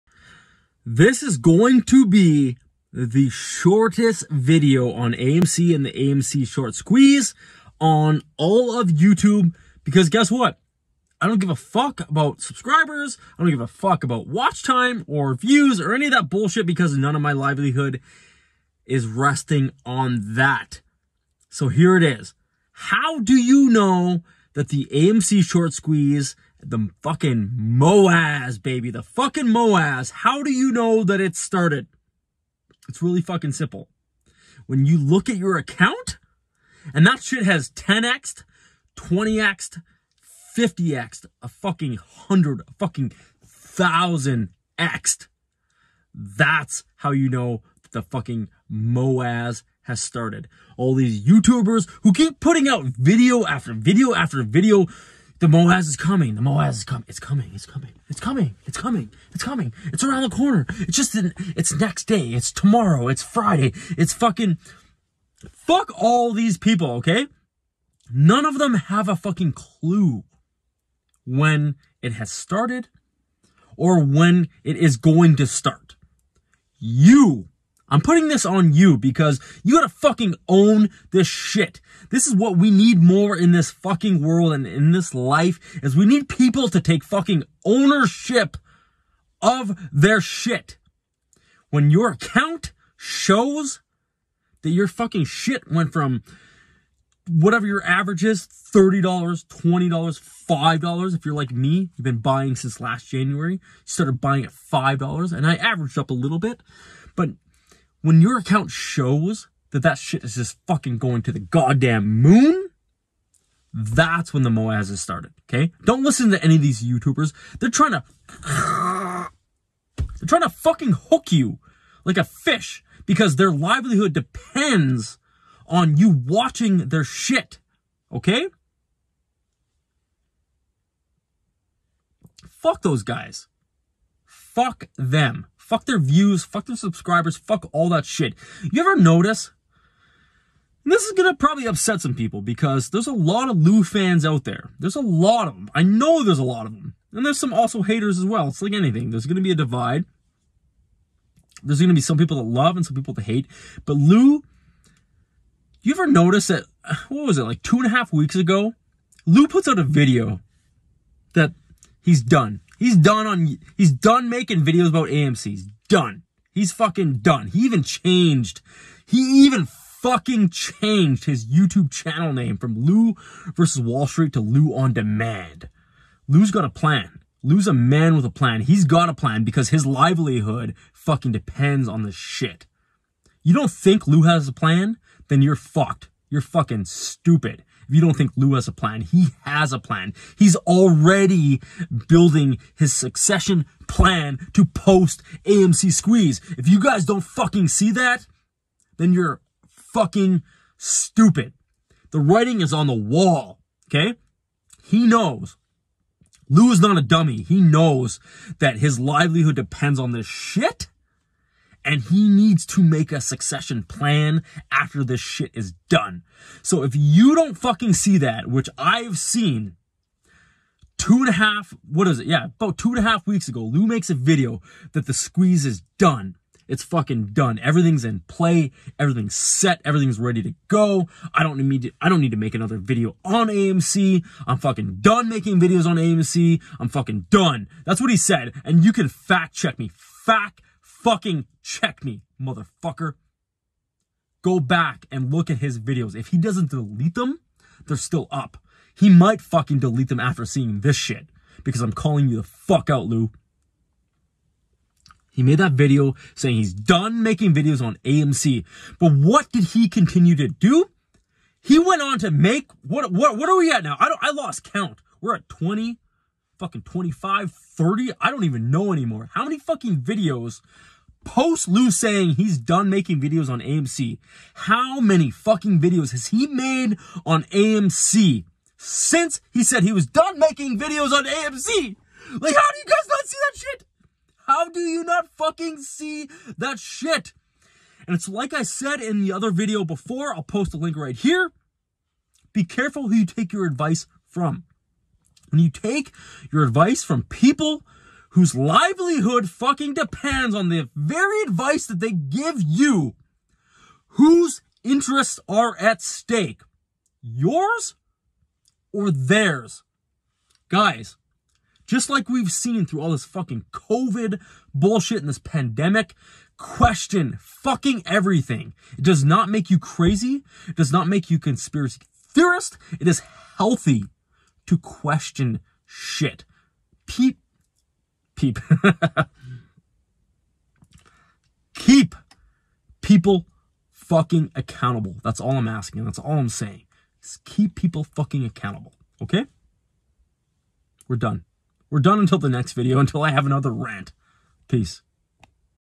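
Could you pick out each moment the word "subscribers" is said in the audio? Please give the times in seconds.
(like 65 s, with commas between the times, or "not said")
12 s, 136 s.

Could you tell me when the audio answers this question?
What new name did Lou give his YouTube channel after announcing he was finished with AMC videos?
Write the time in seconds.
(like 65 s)
174 s.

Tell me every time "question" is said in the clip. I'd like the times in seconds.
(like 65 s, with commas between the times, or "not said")
316 s, 324 s.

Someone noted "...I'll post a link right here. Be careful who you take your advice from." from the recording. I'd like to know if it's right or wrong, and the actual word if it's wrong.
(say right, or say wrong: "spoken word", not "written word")
right.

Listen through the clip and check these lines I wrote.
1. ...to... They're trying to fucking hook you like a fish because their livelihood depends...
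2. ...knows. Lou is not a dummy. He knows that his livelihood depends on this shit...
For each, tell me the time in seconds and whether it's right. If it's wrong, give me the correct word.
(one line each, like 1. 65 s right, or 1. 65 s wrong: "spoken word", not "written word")
1. 117 s right
2. 205 s right.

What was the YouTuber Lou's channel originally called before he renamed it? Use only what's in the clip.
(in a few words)
Lou versus Wall Street.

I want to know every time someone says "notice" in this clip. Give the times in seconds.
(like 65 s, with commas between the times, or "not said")
138 s, 156 s.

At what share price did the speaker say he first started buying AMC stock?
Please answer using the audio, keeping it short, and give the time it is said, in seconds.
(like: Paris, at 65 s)
$5, at 103 s.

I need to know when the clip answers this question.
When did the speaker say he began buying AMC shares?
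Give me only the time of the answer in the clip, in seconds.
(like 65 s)
102 s.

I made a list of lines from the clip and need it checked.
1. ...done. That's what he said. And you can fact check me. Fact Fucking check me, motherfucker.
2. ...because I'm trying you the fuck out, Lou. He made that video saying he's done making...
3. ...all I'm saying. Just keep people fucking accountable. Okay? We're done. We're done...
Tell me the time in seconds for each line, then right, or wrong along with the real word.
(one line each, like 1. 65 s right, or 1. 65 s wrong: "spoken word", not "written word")
1. 237 s right
2. 251 s wrong: "calling", not "trying"
3. 336 s right.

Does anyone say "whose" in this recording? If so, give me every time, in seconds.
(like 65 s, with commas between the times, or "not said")
298 s, 304 s.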